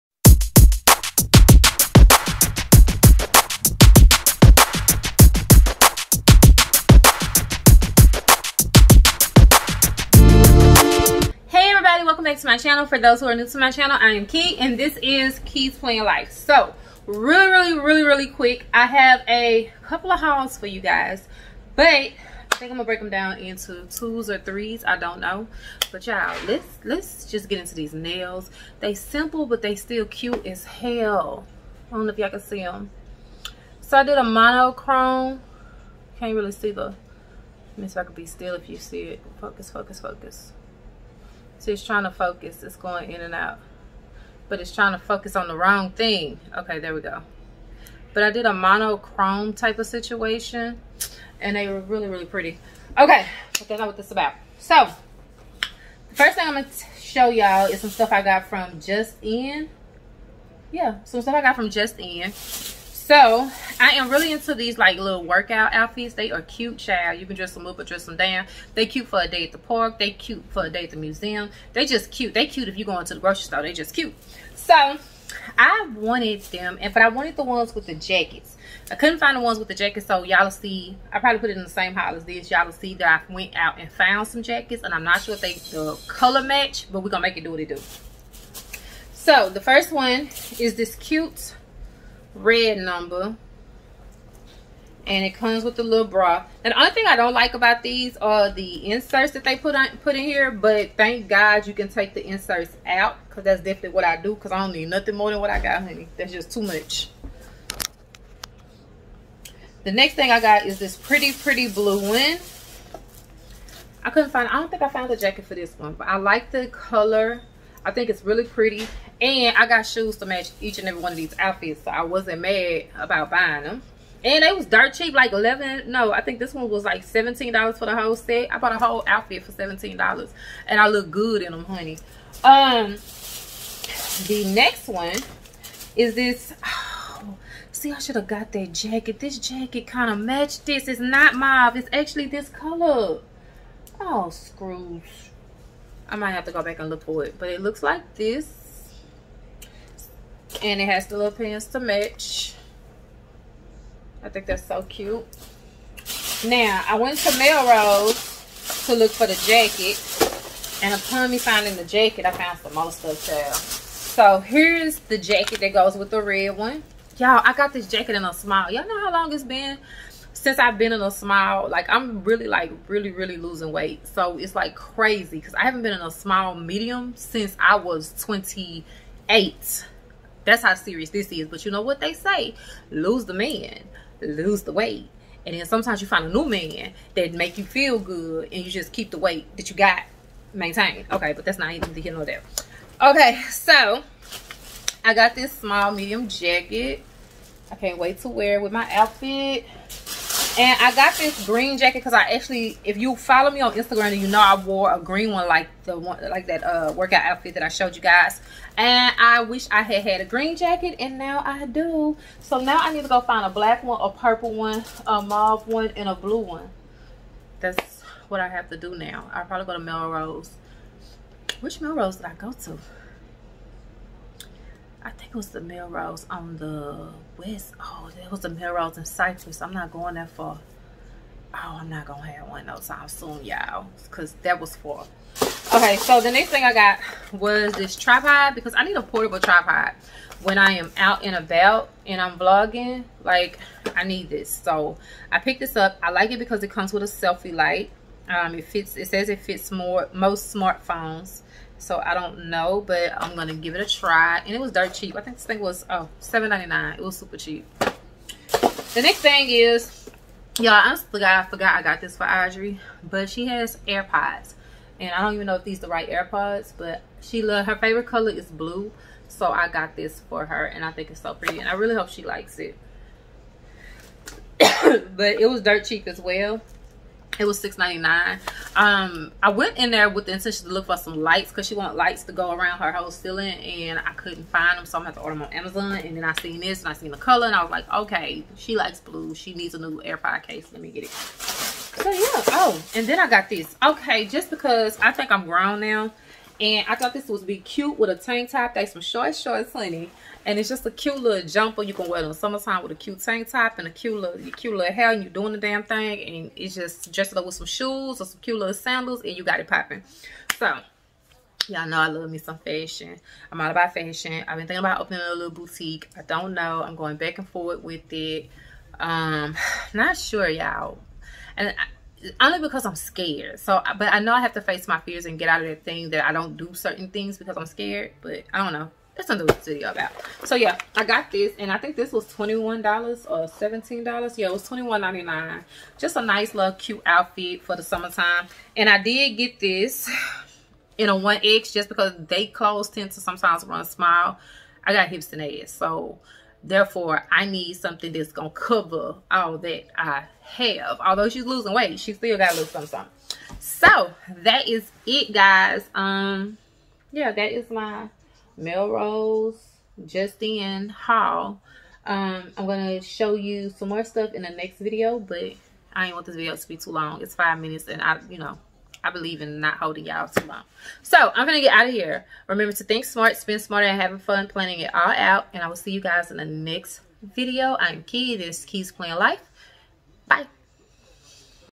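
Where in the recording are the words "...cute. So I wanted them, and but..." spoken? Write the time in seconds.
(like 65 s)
73 s.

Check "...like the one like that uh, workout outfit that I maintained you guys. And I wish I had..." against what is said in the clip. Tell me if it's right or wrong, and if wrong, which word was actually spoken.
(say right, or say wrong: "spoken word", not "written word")
wrong: "showed", not "maintained".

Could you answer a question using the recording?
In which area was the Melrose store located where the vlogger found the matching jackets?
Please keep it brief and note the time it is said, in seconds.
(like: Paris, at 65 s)
Cypress, at 229 s.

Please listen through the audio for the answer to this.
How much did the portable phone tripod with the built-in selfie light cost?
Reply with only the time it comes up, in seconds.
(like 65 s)
256 s.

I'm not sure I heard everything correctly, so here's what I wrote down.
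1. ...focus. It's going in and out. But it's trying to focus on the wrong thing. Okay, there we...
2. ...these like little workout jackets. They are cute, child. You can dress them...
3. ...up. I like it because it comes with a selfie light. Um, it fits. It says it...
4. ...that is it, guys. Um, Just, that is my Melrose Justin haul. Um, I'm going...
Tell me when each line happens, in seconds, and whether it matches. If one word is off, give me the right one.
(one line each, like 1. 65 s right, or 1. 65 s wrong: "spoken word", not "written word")
1. 42 s right
2. 64 s wrong: "outfits", not "jackets"
3. 245 s right
4. 354 s wrong: "Yeah", not "Just".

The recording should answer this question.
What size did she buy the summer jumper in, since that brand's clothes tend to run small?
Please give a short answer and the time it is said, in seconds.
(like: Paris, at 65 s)
1X, at 341 s.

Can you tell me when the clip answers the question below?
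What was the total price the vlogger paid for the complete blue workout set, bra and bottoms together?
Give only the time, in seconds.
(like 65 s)
127 s.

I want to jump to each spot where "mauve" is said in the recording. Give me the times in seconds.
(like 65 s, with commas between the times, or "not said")
141 s, 215 s.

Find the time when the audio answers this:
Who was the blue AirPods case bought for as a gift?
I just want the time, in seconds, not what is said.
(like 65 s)
262 s.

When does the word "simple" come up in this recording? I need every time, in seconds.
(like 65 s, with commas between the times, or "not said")
28 s.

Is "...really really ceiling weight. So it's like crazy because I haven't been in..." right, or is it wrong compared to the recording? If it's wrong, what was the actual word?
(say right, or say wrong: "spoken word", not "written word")
wrong: "losing", not "ceiling".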